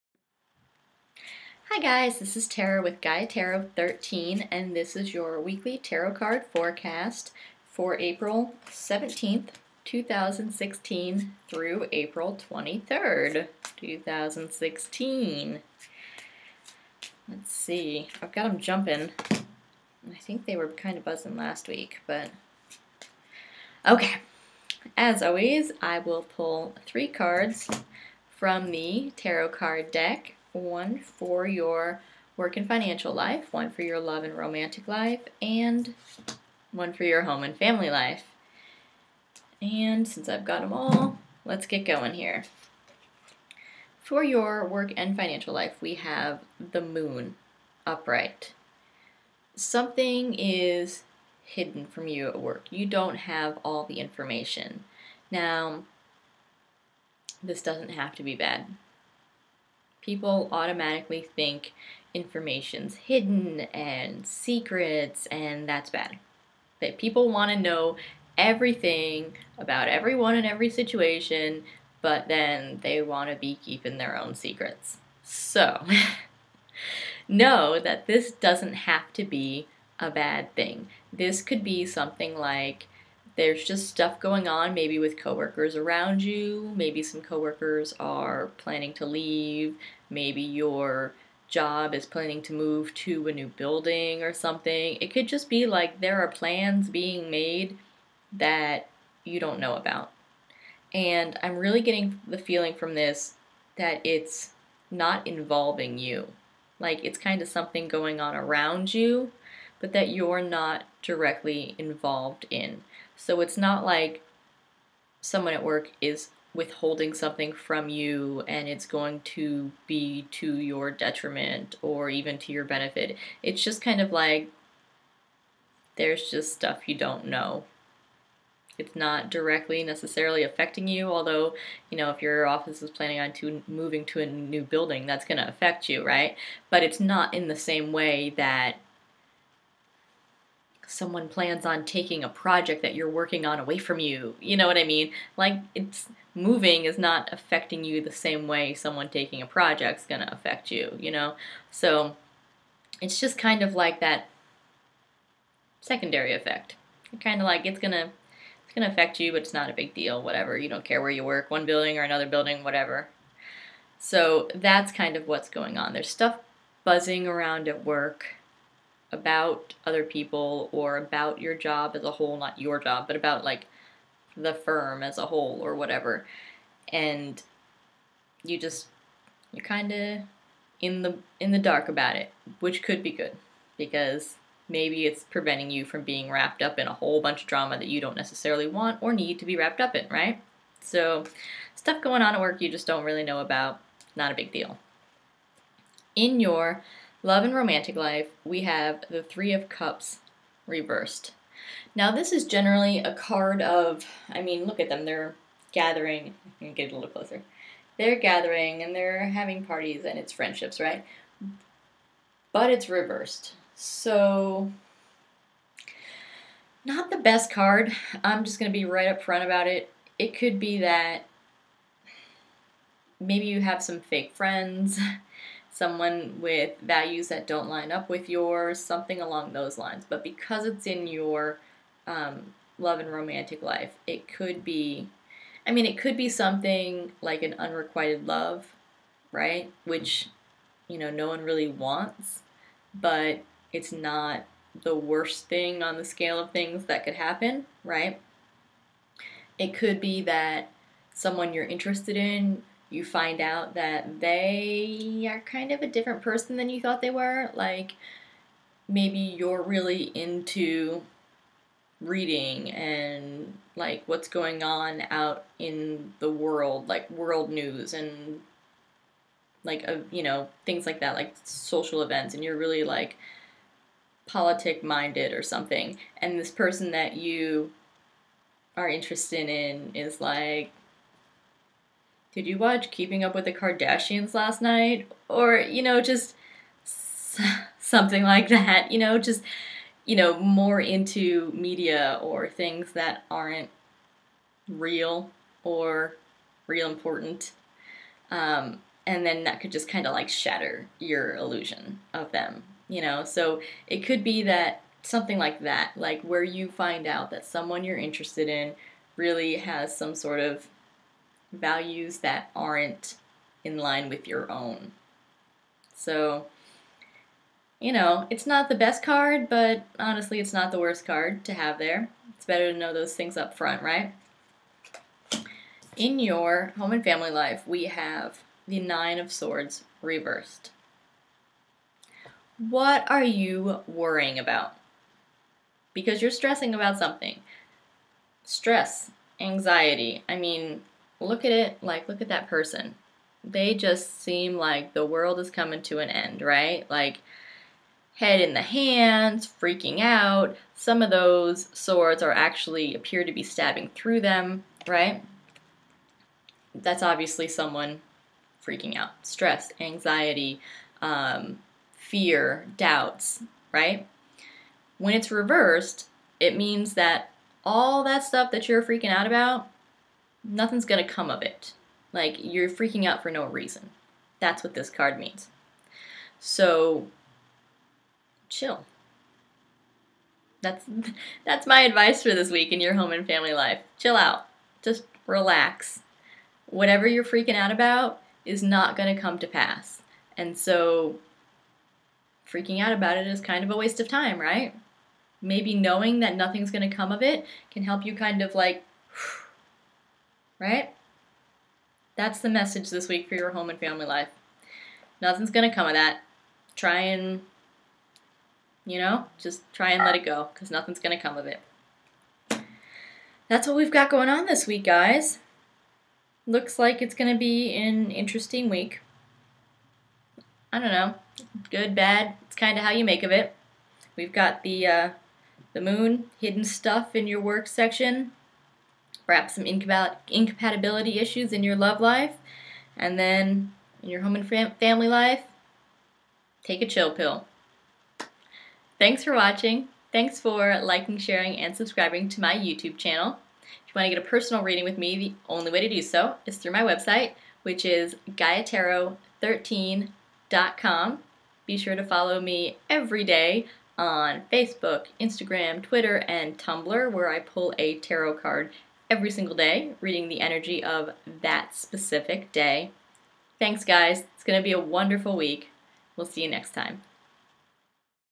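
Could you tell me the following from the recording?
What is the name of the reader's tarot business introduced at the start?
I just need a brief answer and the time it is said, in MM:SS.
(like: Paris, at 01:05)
Gaia Tarot 13, at 00:02.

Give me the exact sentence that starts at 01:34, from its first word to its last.
It could just be like there are plans being made that you don't know about.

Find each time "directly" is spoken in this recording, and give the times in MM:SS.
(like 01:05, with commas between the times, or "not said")
01:51, 02:09.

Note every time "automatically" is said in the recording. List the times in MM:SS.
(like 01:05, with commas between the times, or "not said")
01:00.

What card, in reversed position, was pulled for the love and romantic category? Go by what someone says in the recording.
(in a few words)
Three of Cups.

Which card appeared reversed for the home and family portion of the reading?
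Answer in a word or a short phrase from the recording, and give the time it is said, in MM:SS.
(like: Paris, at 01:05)
Nine of Swords, at 05:28.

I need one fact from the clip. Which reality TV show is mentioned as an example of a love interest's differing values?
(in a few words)
Keeping Up with the Kardashians.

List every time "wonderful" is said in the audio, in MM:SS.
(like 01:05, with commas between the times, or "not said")
07:44.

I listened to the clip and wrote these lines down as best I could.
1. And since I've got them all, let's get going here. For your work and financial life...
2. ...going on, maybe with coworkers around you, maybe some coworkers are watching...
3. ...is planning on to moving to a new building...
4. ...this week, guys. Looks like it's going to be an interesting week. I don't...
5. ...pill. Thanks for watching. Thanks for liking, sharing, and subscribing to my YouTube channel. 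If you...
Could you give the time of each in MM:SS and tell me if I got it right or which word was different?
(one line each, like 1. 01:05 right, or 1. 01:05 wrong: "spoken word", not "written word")
1. 00:39 right
2. 01:24 wrong: "planning", not "watching"
3. 02:12 right
4. 06:54 right
5. 07:17 right.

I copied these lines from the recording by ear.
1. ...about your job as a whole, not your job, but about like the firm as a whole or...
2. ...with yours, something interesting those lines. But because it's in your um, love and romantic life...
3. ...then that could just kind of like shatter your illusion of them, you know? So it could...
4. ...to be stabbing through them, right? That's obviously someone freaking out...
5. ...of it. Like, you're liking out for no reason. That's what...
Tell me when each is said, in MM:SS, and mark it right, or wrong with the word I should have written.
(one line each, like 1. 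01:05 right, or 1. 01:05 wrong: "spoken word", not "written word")
1. 02:50 right
2. 03:48 wrong: "along", not "interesting"
3. 04:59 right
4. 05:53 right
5. 06:11 wrong: "freaking", not "liking".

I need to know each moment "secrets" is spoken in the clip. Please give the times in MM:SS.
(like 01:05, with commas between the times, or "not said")
01:04, 01:14.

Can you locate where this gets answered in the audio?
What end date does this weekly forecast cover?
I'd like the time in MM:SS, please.
00:11.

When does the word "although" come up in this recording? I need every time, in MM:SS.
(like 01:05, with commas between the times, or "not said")
02:11.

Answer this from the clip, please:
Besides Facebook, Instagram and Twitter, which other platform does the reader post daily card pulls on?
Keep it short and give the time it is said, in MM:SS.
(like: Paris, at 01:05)
Tumblr, at 07:36.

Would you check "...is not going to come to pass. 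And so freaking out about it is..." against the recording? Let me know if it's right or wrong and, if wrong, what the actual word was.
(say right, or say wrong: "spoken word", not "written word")
right.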